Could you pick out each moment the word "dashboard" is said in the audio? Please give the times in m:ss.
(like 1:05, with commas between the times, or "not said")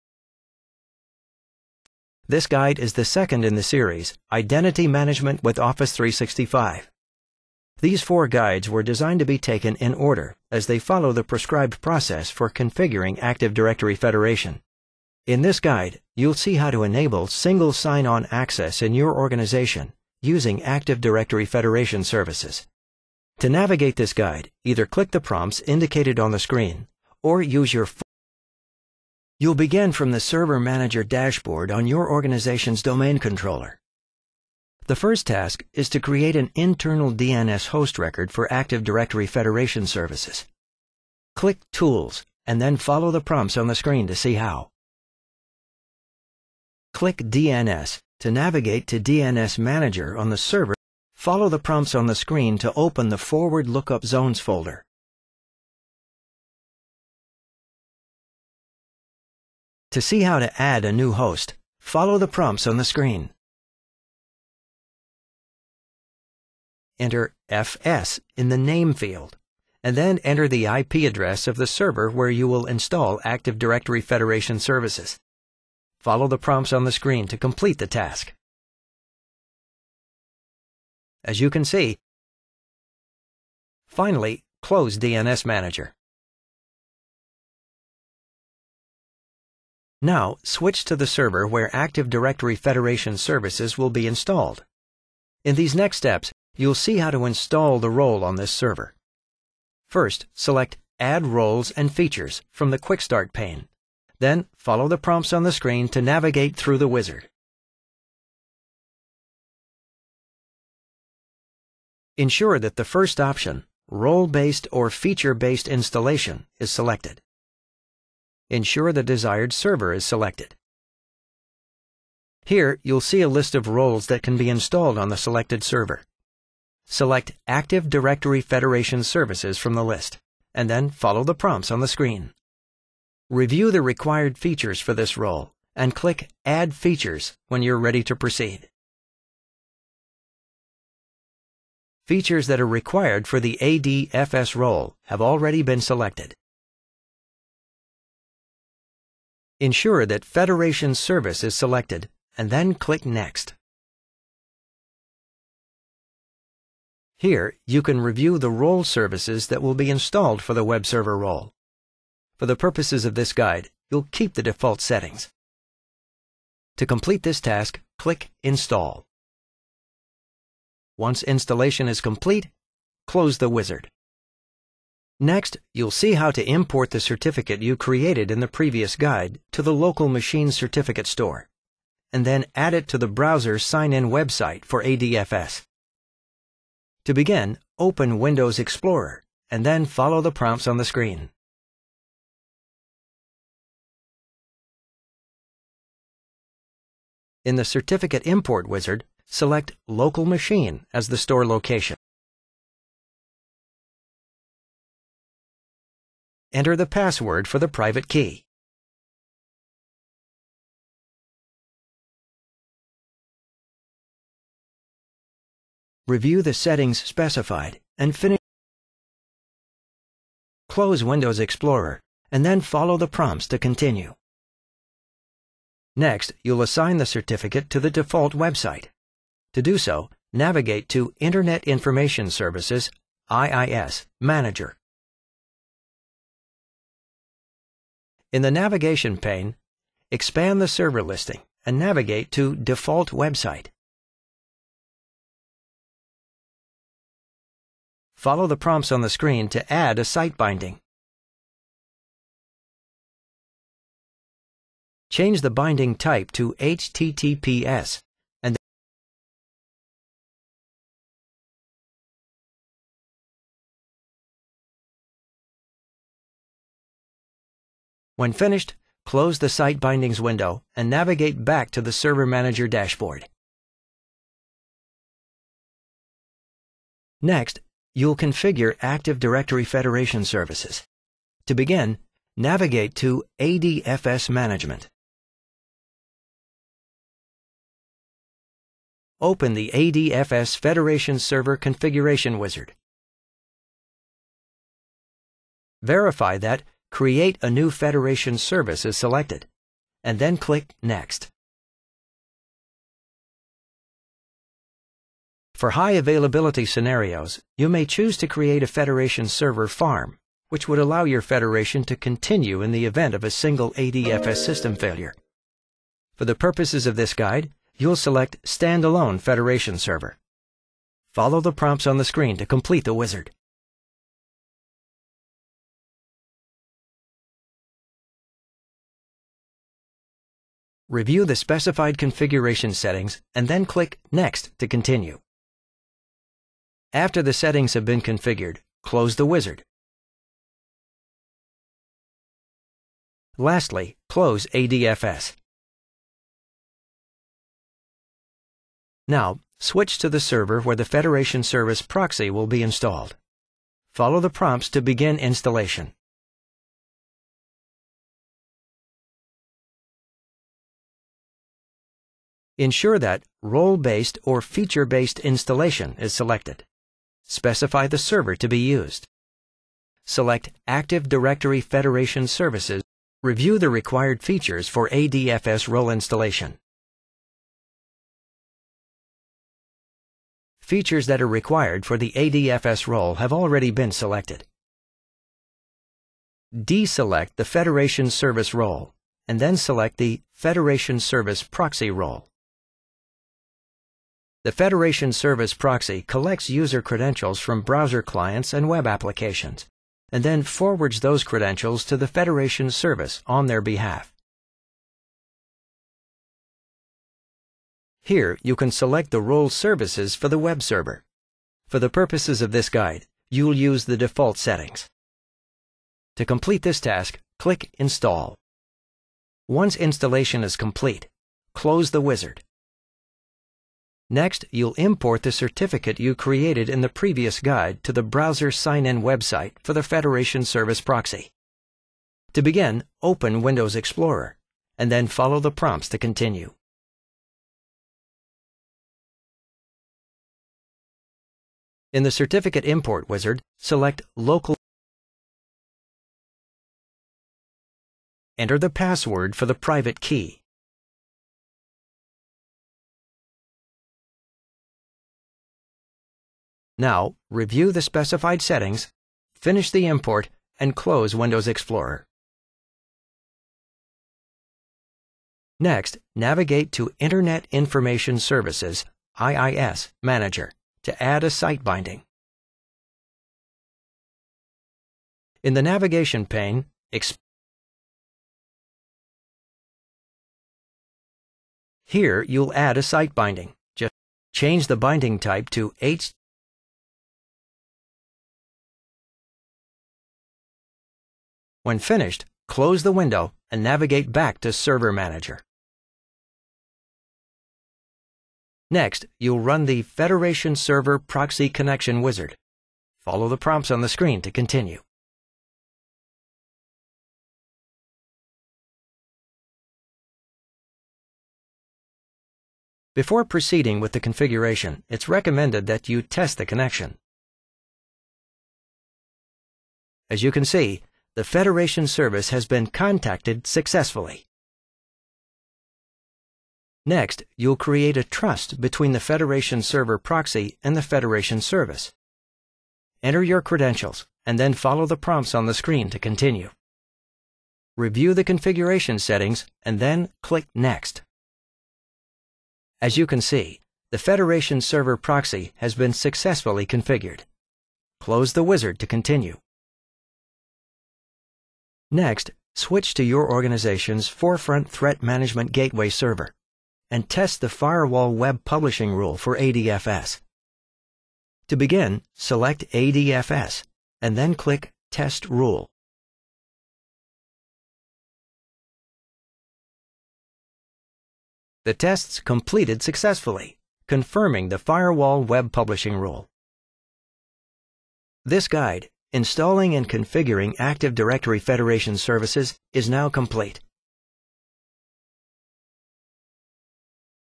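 0:31, 4:32.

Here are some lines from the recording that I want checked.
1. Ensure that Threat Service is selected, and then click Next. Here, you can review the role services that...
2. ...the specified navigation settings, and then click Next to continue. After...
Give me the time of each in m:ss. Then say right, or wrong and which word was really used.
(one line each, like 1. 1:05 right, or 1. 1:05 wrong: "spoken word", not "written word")
1. 2:29 wrong: "Federation", not "Threat"
2. 5:31 wrong: "configuration", not "navigation".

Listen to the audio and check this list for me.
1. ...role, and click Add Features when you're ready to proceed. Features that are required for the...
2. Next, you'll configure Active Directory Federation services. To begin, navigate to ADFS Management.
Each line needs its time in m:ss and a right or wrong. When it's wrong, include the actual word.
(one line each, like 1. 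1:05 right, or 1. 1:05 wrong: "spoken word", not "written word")
1. 2:15 right
2. 4:37 right.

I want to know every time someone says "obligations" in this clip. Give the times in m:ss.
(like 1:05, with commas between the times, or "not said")
not said.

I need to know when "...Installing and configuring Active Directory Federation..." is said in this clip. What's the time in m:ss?
9:39.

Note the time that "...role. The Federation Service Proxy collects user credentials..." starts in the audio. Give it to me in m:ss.
6:31.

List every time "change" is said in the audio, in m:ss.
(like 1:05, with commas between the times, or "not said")
4:15, 8:04.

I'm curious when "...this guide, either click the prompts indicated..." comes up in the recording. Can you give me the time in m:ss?
0:23.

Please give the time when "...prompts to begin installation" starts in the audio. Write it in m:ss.
5:54.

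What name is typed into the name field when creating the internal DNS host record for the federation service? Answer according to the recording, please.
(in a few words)
FS.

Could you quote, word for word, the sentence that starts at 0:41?
Click Tools and then follow the prompts on the screen to see how.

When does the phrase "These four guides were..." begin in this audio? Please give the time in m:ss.
0:07.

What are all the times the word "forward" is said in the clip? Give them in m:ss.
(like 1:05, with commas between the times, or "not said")
0:53, 6:40.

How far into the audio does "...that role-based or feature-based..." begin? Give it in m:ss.
6:02.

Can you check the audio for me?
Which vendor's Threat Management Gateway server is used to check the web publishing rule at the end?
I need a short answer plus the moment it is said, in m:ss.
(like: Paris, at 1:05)
Forefront, at 9:14.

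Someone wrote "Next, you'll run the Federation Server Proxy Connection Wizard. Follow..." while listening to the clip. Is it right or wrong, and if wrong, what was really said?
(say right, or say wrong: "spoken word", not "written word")
right.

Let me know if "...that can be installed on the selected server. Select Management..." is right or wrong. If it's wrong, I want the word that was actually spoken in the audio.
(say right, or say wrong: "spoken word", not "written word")
wrong: "Active", not "Management".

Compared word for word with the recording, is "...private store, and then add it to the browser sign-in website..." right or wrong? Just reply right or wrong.
wrong.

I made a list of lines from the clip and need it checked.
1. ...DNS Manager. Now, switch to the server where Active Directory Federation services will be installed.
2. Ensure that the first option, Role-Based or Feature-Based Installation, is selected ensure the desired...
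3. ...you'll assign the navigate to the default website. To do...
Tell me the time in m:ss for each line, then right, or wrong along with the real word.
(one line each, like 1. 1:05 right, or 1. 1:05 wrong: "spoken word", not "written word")
1. 1:24 right
2. 1:52 right
3. 3:46 wrong: "certificate", not "navigate".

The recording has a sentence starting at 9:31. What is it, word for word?
The tests completed successfully, confirming the Firewall Web Publishing rule.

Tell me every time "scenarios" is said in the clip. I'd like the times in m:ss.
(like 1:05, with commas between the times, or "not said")
5:06.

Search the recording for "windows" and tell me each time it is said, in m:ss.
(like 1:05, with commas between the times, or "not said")
3:08, 3:41, 4:30, 7:13, 7:41, 8:12.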